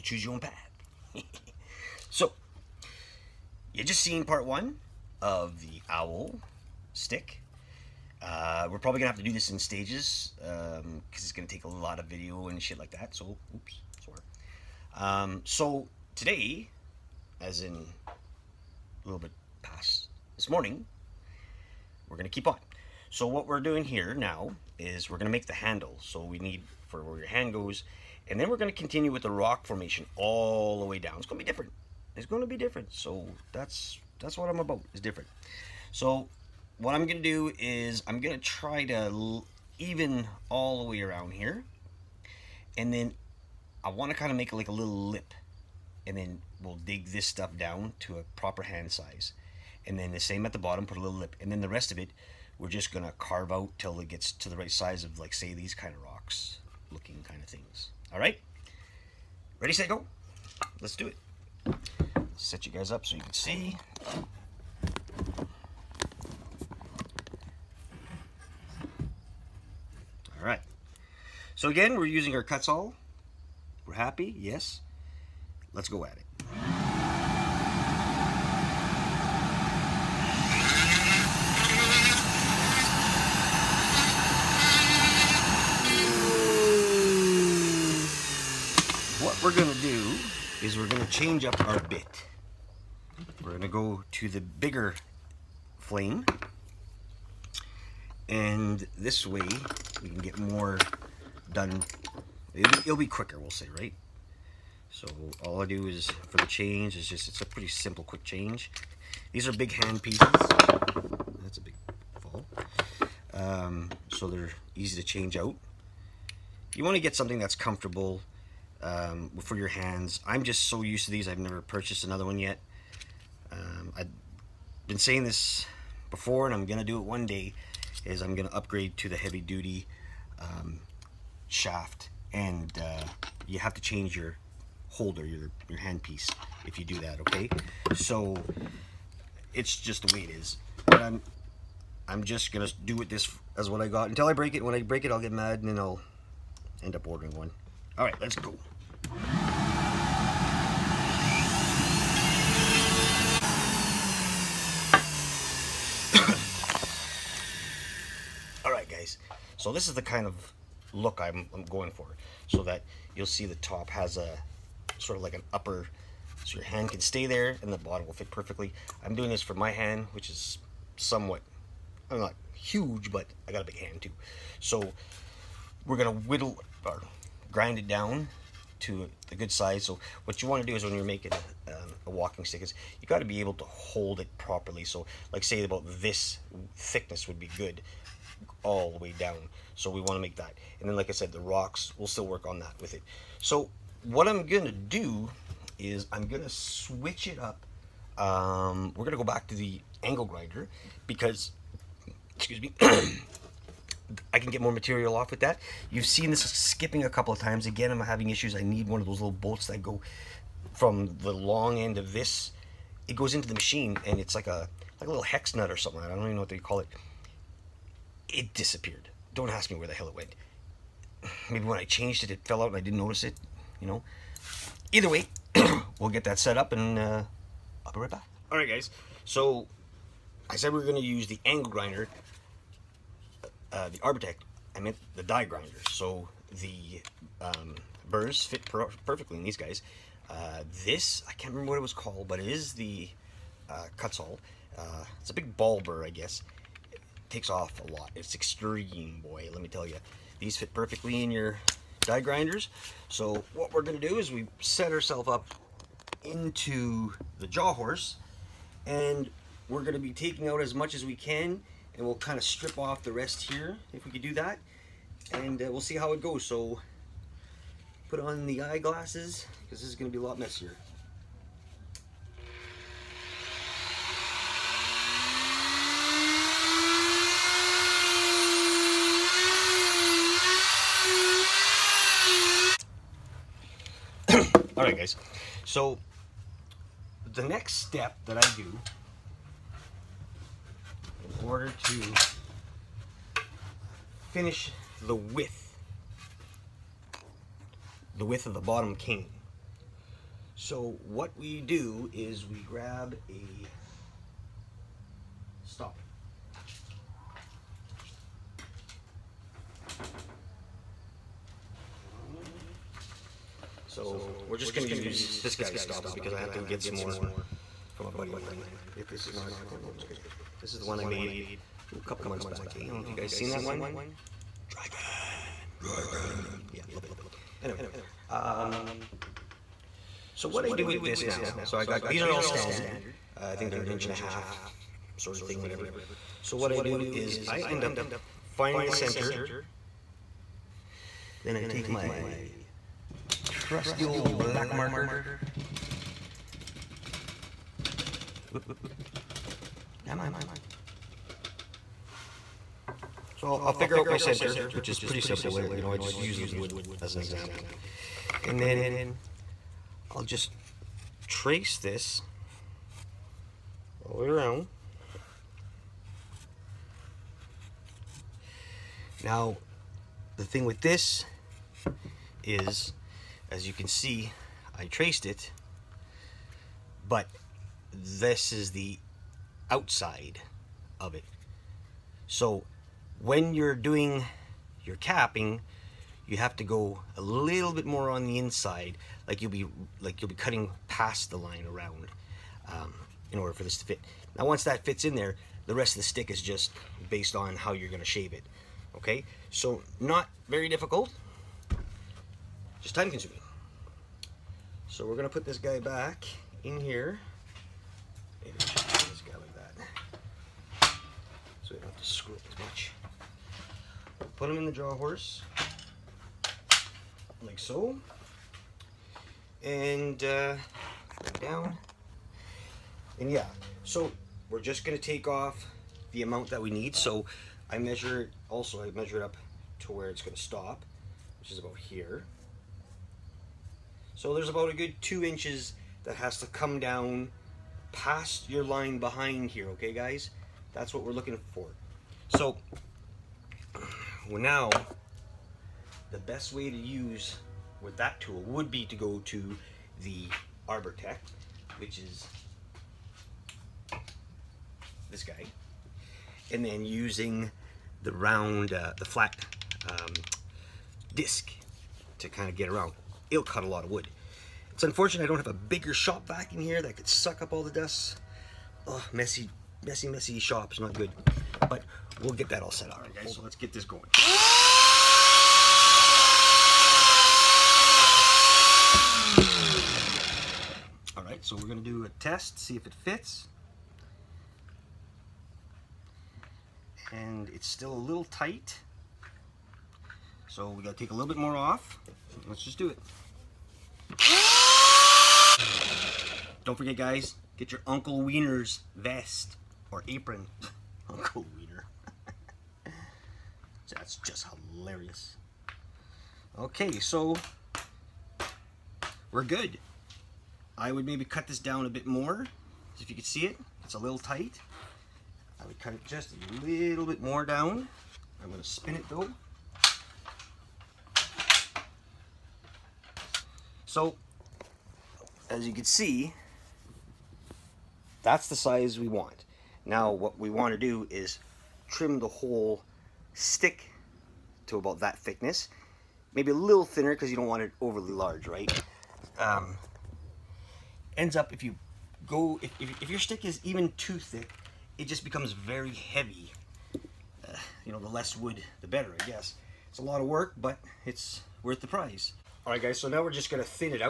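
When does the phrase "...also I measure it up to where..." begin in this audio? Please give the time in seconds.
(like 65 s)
428 s.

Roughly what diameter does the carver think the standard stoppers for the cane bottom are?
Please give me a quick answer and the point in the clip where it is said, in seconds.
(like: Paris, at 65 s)
1.5 inches, at 333 s.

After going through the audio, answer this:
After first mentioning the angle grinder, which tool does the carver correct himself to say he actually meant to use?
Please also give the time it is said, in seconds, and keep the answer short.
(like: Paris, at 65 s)
die grinder, at 235 s.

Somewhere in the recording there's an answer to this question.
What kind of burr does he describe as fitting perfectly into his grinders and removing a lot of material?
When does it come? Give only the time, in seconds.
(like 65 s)
245 s.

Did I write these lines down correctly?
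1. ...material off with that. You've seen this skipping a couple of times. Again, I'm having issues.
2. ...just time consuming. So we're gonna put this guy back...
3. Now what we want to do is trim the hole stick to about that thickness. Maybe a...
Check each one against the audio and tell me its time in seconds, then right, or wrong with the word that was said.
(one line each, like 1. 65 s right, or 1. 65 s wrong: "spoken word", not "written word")
1. 204 s right
2. 402 s right
3. 529 s right.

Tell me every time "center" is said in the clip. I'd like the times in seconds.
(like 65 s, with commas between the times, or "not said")
338 s, 354 s.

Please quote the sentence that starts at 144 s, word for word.
When I break it, I'll get mad, and then I'll end up ordering one.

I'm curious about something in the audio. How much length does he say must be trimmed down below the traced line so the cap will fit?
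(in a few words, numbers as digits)
2 inches.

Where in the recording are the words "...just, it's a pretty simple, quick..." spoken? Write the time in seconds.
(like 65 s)
107 s.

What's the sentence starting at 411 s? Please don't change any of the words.
So we don't have to screw it as much.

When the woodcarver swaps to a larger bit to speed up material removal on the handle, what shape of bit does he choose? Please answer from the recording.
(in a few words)
bigger flame.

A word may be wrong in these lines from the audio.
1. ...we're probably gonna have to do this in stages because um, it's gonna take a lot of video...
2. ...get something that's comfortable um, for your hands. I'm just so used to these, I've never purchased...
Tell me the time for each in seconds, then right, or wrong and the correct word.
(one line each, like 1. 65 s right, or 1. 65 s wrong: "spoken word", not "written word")
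1. 8 s right
2. 117 s right.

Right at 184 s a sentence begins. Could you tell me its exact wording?
So like say about this thickness would be good all the way down.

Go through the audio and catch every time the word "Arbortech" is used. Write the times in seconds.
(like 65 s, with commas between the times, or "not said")
233 s, 450 s.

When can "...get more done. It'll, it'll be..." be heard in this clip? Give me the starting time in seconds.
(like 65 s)
100 s.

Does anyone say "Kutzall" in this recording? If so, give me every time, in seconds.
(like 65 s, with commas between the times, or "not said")
72 s, 243 s.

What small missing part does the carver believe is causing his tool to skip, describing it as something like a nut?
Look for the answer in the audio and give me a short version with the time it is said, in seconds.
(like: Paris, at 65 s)
hex nut, at 215 s.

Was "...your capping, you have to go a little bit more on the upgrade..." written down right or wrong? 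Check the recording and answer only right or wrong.
wrong.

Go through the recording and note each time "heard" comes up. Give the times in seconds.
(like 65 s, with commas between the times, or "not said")
not said.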